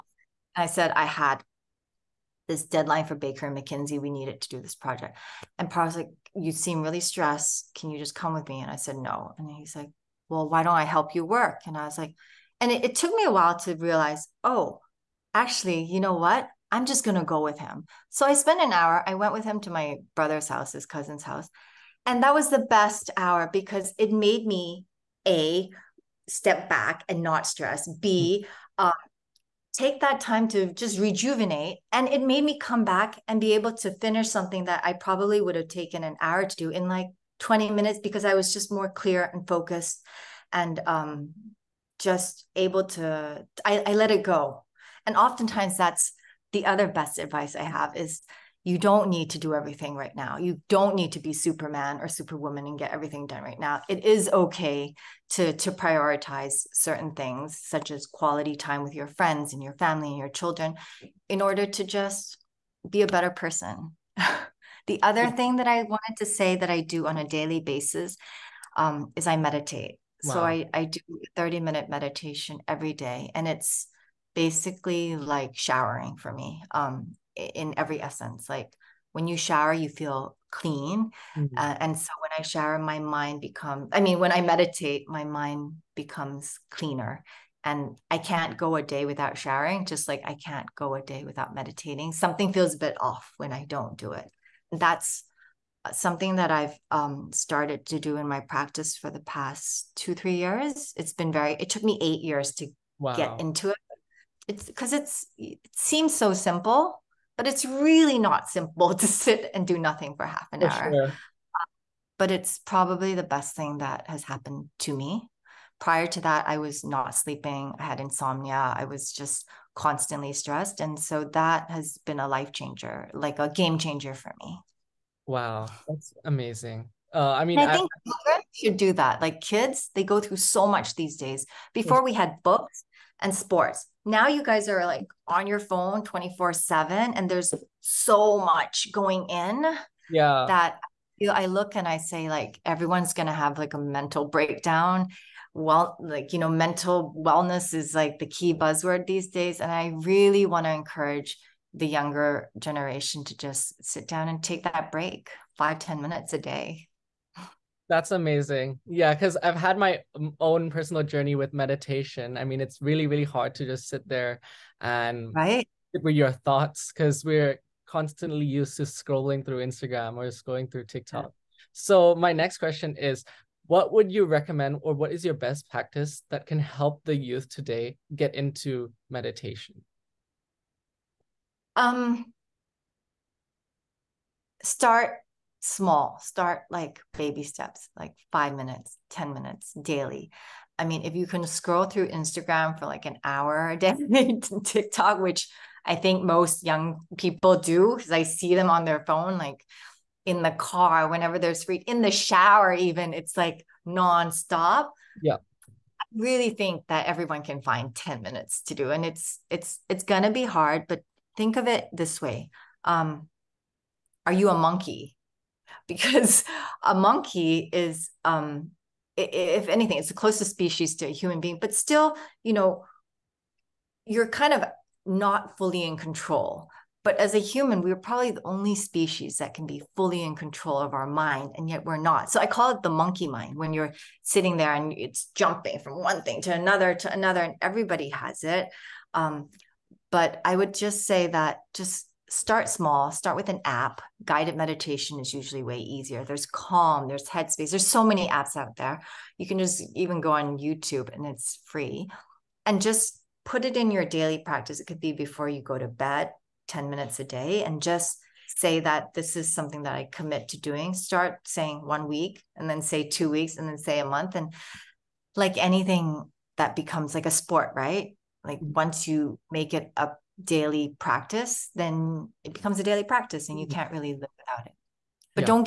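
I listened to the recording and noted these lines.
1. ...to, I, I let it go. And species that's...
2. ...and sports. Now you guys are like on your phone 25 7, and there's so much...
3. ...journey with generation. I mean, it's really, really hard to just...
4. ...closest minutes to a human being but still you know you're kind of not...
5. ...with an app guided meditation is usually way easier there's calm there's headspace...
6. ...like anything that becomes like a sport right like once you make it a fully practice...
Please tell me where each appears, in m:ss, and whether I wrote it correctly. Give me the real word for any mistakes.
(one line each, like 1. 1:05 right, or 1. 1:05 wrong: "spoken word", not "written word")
1. 0:42 wrong: "oftentimes", not "species"
2. 2:13 wrong: "24", not "25"
3. 2:41 wrong: "meditation", not "generation"
4. 3:40 wrong: "species", not "minutes"
5. 4:03 right
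6. 4:25 wrong: "daily", not "fully".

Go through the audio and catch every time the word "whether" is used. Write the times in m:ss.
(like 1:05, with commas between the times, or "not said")
not said.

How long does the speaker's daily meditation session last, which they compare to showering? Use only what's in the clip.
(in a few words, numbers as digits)
30 minutes.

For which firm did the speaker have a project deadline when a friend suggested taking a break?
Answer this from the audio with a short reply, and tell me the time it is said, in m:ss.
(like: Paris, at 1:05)
Baker and McKenzie, at 0:03.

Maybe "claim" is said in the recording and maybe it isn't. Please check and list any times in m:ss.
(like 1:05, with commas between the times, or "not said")
not said.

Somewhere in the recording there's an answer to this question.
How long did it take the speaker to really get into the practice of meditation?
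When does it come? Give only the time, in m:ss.
1:42.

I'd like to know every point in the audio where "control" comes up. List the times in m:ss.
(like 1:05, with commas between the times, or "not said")
3:45, 3:50.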